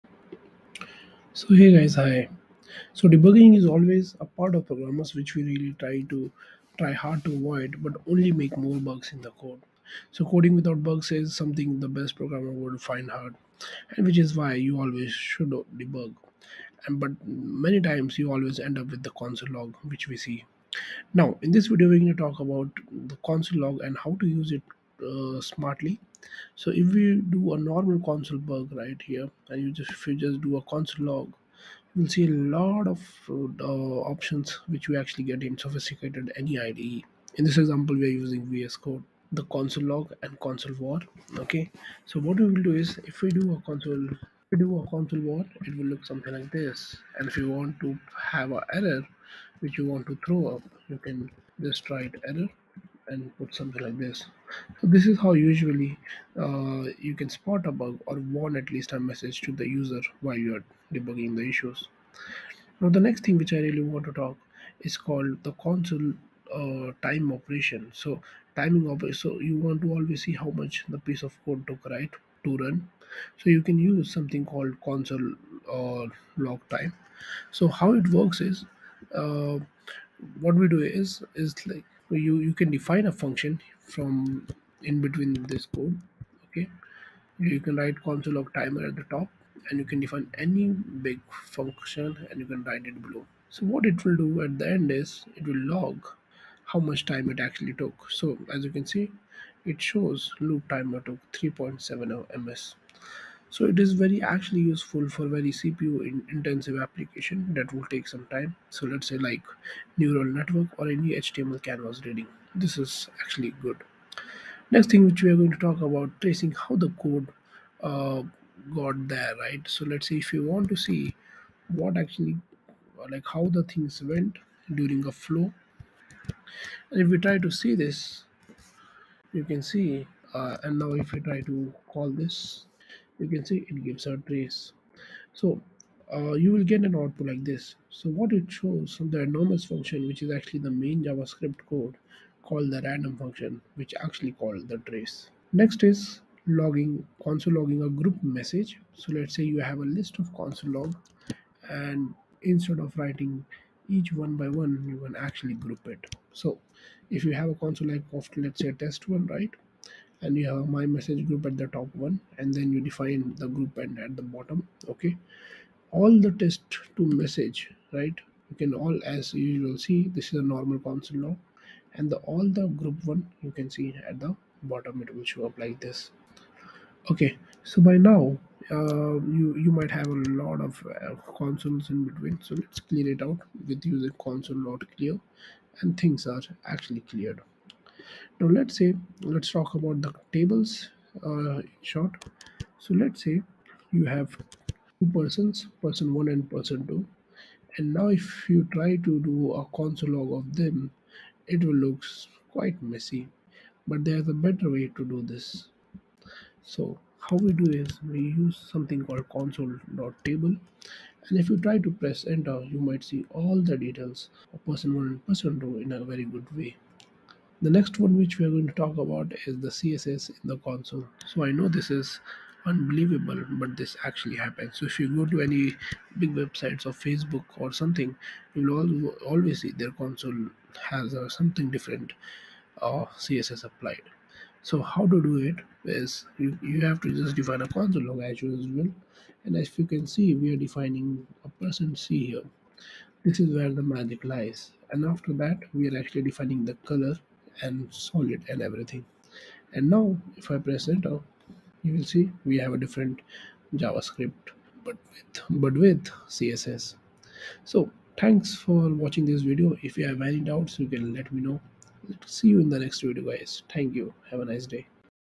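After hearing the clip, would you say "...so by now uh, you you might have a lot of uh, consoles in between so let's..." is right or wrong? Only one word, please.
right.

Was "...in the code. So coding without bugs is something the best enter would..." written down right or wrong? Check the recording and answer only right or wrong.
wrong.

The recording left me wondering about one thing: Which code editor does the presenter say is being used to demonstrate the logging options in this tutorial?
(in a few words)
VS Code.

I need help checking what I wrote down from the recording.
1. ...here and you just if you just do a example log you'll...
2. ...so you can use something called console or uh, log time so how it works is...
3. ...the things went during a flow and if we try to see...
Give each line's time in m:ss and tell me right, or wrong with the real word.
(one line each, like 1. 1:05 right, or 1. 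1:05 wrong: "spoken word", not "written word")
1. 0:29 wrong: "console", not "example"
2. 1:13 right
3. 2:03 right.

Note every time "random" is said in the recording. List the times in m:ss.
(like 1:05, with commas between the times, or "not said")
2:22.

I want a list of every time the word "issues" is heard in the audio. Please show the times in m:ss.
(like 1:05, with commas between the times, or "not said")
1:01.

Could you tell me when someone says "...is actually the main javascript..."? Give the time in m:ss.
2:20.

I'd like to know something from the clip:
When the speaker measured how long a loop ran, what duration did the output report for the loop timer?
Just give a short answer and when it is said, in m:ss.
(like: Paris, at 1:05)
3.7 ms, at 1:41.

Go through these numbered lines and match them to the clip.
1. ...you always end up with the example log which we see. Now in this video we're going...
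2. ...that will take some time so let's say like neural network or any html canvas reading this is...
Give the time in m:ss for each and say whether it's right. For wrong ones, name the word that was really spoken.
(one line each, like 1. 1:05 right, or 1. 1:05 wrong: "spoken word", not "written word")
1. 0:18 wrong: "console", not "example"
2. 1:47 right.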